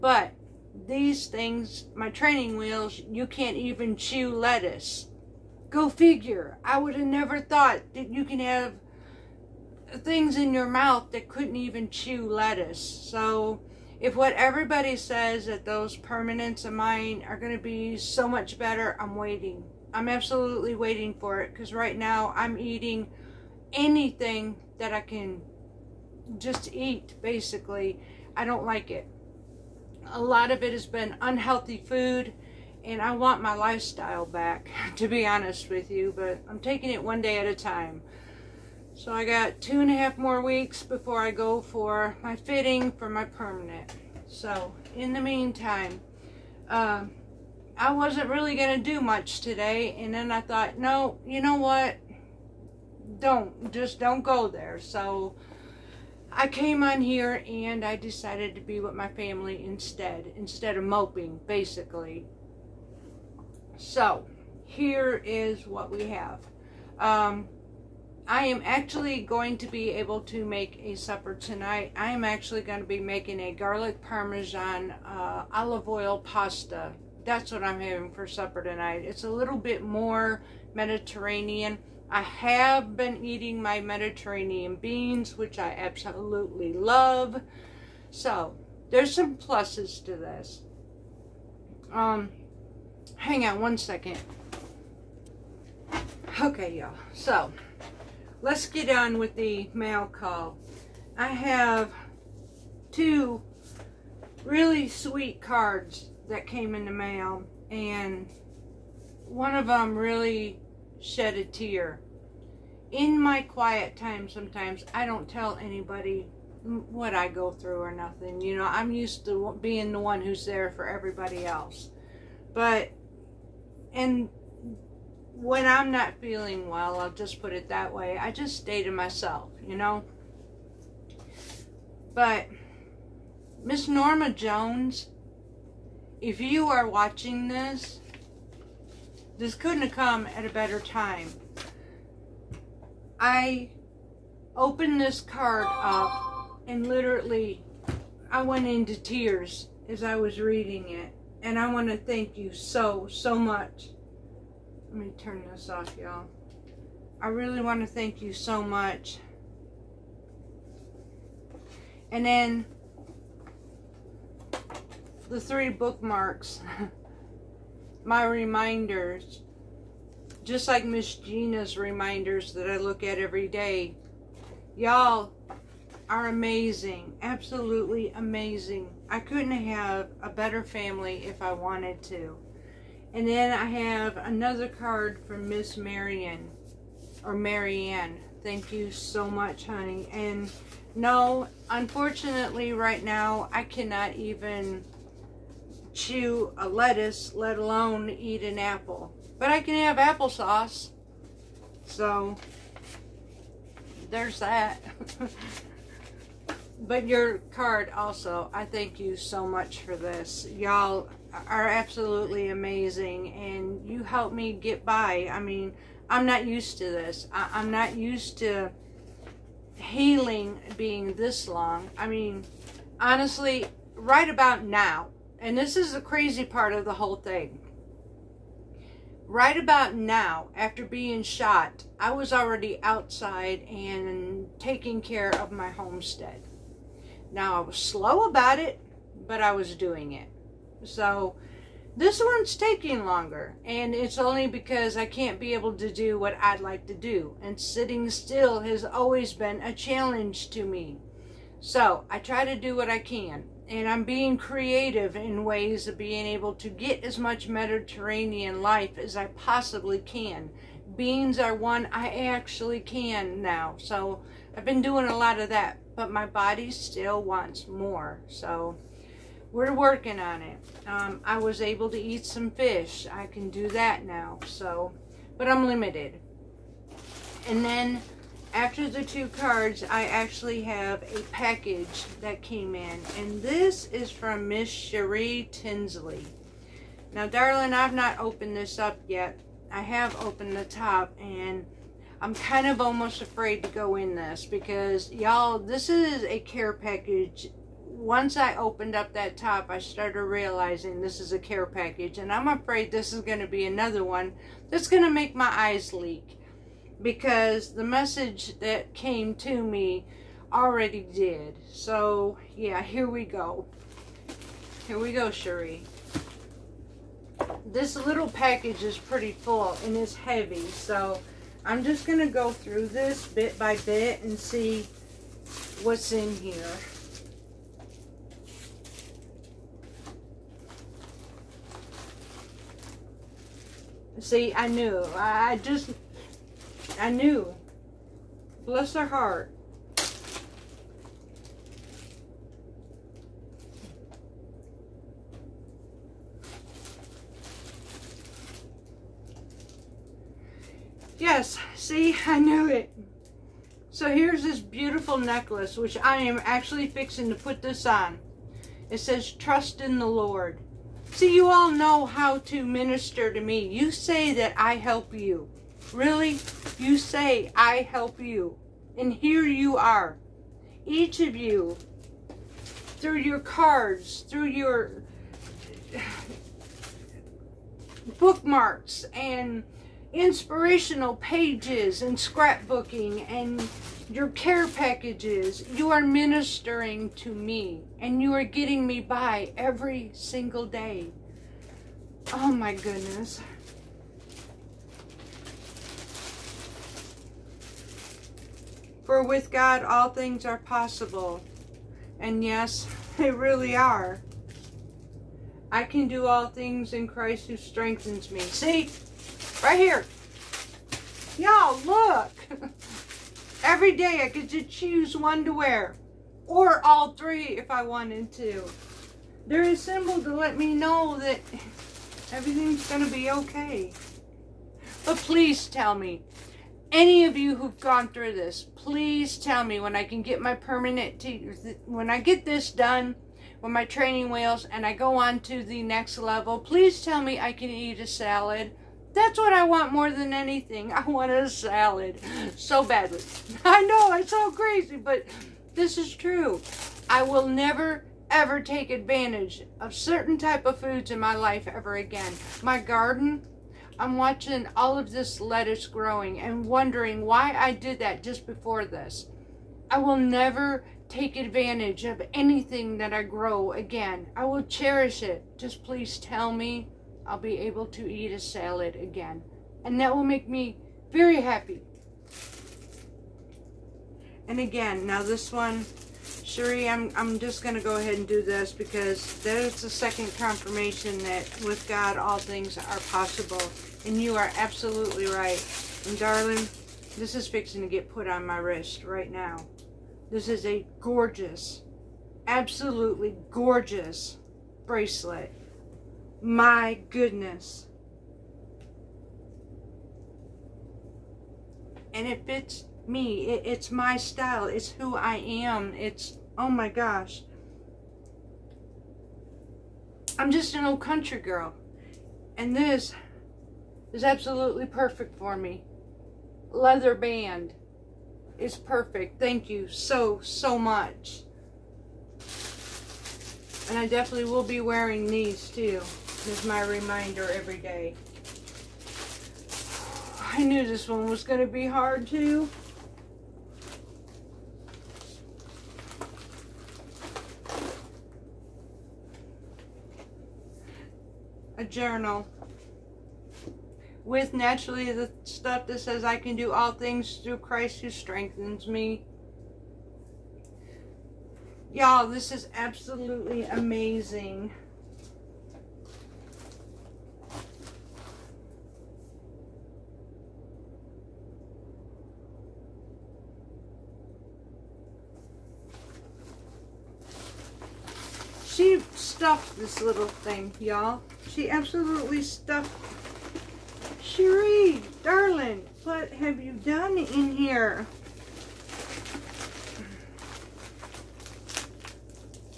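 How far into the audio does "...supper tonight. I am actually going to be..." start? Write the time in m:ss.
1:10.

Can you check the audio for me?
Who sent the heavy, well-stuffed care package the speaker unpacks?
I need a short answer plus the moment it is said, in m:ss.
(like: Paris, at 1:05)
Cherie Tinsley, at 4:44.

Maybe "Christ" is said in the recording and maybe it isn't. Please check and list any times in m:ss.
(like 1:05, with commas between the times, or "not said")
6:47, 9:07.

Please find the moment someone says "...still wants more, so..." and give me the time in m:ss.
4:26.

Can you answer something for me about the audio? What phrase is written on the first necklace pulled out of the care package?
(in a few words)
Trust in the Lord.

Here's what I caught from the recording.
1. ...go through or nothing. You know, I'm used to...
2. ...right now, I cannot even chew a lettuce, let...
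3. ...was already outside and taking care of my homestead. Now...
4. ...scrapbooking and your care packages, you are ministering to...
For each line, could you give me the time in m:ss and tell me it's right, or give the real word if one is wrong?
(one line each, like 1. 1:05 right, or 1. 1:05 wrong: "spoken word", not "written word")
1. 1:57 right
2. 3:12 right
3. 3:52 right
4. 6:22 right.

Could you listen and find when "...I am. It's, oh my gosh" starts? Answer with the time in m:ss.
8:25.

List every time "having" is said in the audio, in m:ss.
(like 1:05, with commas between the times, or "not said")
1:17.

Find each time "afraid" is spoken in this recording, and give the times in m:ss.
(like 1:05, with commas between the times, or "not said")
4:53, 5:02.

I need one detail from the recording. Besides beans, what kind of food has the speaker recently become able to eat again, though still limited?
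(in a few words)
Fish.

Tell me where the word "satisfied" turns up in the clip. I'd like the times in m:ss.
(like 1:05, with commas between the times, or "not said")
not said.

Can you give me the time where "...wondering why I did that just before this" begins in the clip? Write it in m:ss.
7:36.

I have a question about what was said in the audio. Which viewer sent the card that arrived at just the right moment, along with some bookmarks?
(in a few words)
Norma Jones.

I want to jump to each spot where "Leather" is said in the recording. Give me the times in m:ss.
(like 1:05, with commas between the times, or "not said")
8:36.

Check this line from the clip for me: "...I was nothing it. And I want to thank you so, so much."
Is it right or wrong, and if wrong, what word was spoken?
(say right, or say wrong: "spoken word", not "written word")
wrong: "reading", not "nothing".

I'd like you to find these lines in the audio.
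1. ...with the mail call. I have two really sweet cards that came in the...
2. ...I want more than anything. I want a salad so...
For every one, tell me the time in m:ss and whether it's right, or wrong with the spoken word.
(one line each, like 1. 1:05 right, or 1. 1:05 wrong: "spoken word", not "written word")
1. 1:39 right
2. 7:19 right.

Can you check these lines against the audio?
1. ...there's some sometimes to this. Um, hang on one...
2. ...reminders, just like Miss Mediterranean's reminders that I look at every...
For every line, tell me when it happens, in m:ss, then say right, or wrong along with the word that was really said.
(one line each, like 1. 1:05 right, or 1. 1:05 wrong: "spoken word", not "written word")
1. 1:28 wrong: "pluses", not "sometimes"
2. 2:48 wrong: "Gina", not "Mediterranean".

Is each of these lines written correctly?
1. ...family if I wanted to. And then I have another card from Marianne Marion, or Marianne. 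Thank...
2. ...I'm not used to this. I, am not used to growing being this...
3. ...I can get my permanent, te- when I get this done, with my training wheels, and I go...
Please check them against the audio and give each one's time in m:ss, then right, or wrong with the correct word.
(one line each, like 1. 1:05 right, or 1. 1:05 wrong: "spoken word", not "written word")
1. 3:00 wrong: "Miss", not "Marianne"
2. 3:36 wrong: "healing", not "growing"
3. 7:09 right.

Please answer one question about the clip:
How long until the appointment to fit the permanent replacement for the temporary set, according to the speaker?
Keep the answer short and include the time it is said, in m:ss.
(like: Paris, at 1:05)
2.5 weeks, at 0:39.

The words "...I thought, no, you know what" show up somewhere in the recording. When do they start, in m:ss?
0:50.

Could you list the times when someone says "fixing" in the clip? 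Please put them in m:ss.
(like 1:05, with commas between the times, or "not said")
5:56, 8:07.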